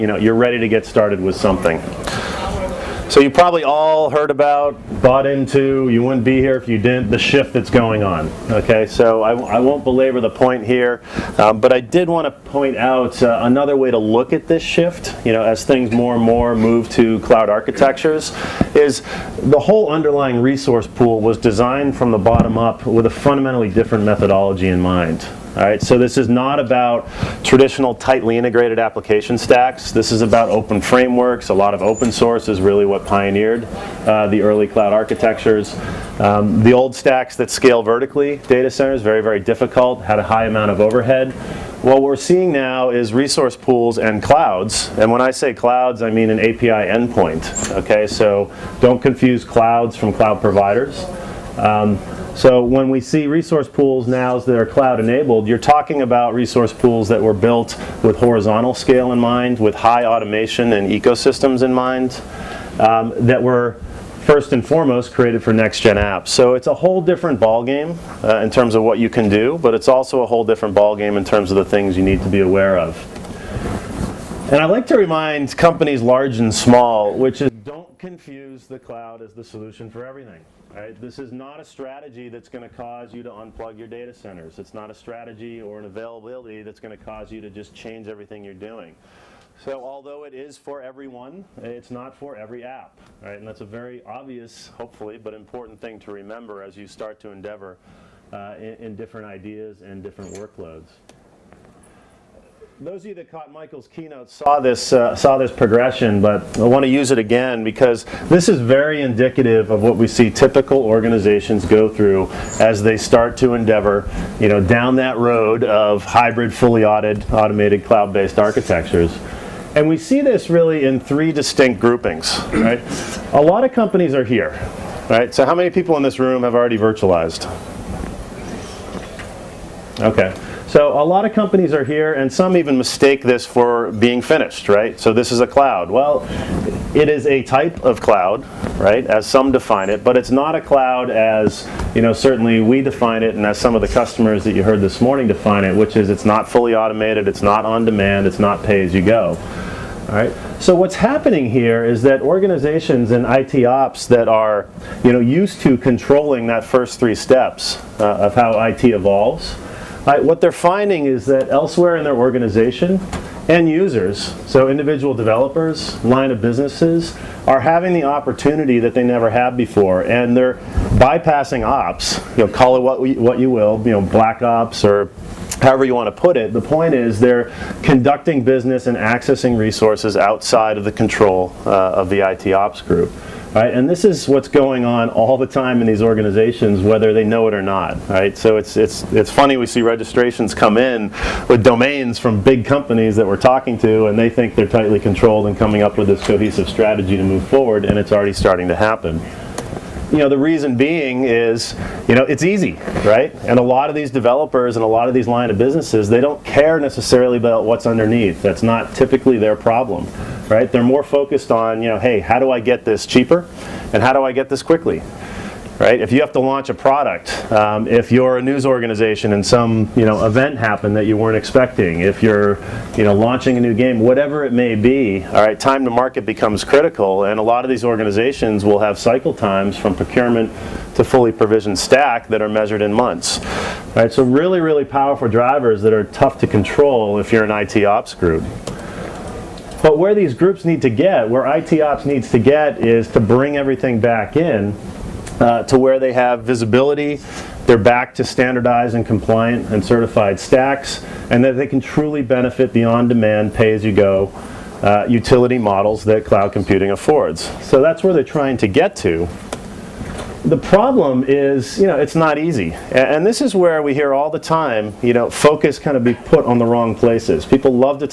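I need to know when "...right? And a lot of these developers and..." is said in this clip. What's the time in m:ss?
3:23.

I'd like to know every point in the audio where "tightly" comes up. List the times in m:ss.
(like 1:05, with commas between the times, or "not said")
0:27, 3:14.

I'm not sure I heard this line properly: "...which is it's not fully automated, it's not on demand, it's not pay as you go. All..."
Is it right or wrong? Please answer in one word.
right.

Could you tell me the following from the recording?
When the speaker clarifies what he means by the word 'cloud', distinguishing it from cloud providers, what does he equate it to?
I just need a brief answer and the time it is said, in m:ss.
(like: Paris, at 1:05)
An API endpoint, at 0:46.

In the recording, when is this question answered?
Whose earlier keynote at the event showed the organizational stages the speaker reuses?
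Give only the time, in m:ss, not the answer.
1:43.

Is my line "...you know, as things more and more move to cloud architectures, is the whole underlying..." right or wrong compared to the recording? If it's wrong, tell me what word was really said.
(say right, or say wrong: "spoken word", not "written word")
right.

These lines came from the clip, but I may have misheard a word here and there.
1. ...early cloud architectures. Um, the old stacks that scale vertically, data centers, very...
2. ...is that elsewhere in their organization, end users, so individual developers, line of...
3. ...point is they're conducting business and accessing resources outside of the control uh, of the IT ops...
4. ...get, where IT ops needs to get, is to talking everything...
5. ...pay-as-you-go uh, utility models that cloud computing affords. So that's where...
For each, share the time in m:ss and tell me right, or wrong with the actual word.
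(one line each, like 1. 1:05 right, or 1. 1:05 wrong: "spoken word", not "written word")
1. 0:34 right
2. 2:41 right
3. 2:56 right
4. 4:00 wrong: "bring", not "talking"
5. 4:13 right.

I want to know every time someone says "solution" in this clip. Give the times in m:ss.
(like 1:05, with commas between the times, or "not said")
1:19.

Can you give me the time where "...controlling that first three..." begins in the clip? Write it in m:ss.
2:35.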